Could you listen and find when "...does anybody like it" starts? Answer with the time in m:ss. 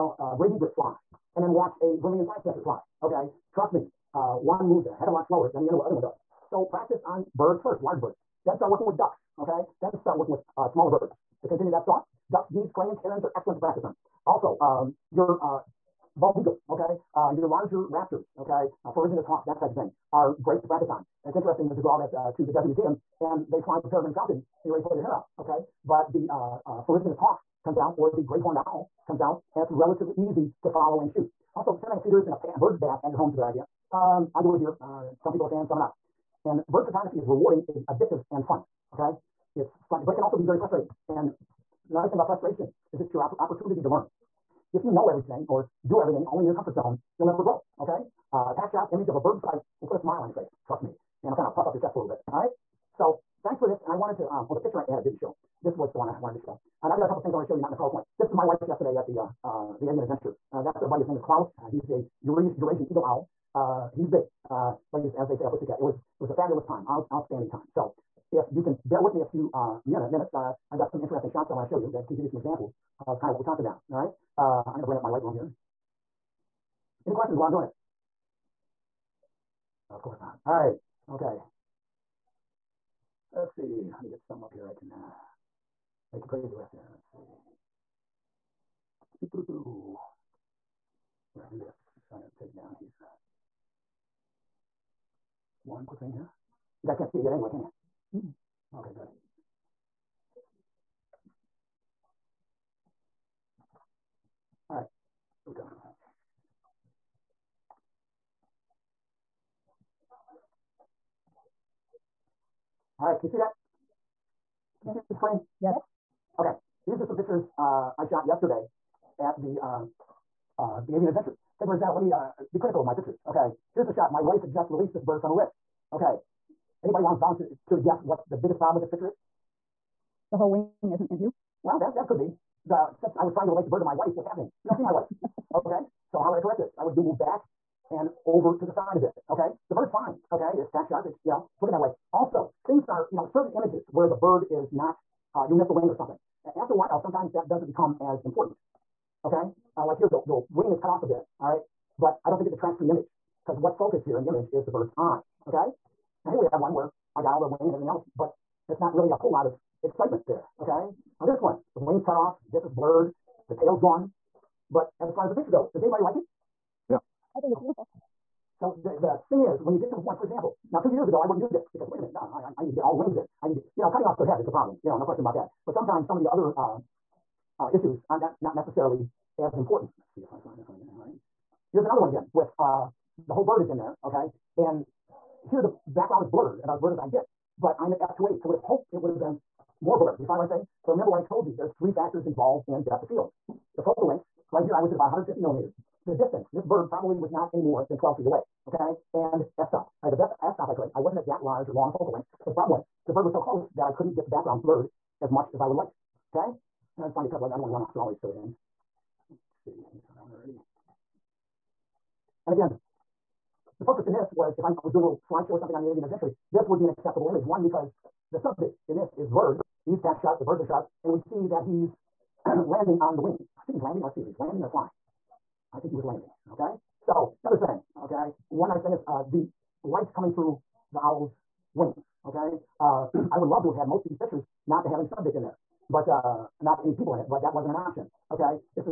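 2:45.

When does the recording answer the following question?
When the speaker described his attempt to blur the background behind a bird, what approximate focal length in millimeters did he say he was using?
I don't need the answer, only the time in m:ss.
3:15.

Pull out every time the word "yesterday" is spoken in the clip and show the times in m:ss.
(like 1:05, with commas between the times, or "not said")
0:58, 1:58.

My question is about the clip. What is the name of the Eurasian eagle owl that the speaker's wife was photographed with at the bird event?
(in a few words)
Klaus.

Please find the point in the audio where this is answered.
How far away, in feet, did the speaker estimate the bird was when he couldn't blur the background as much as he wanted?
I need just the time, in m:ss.
3:17.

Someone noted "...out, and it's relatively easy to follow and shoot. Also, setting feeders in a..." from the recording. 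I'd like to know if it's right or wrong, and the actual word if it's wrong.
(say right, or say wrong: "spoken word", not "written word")
right.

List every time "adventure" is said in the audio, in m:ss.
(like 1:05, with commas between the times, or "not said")
1:00, 2:01, 3:36.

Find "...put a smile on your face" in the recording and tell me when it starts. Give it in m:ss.
0:49.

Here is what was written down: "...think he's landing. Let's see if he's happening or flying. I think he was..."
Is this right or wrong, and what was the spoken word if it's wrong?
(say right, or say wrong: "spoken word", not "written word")
wrong: "landing", not "happening".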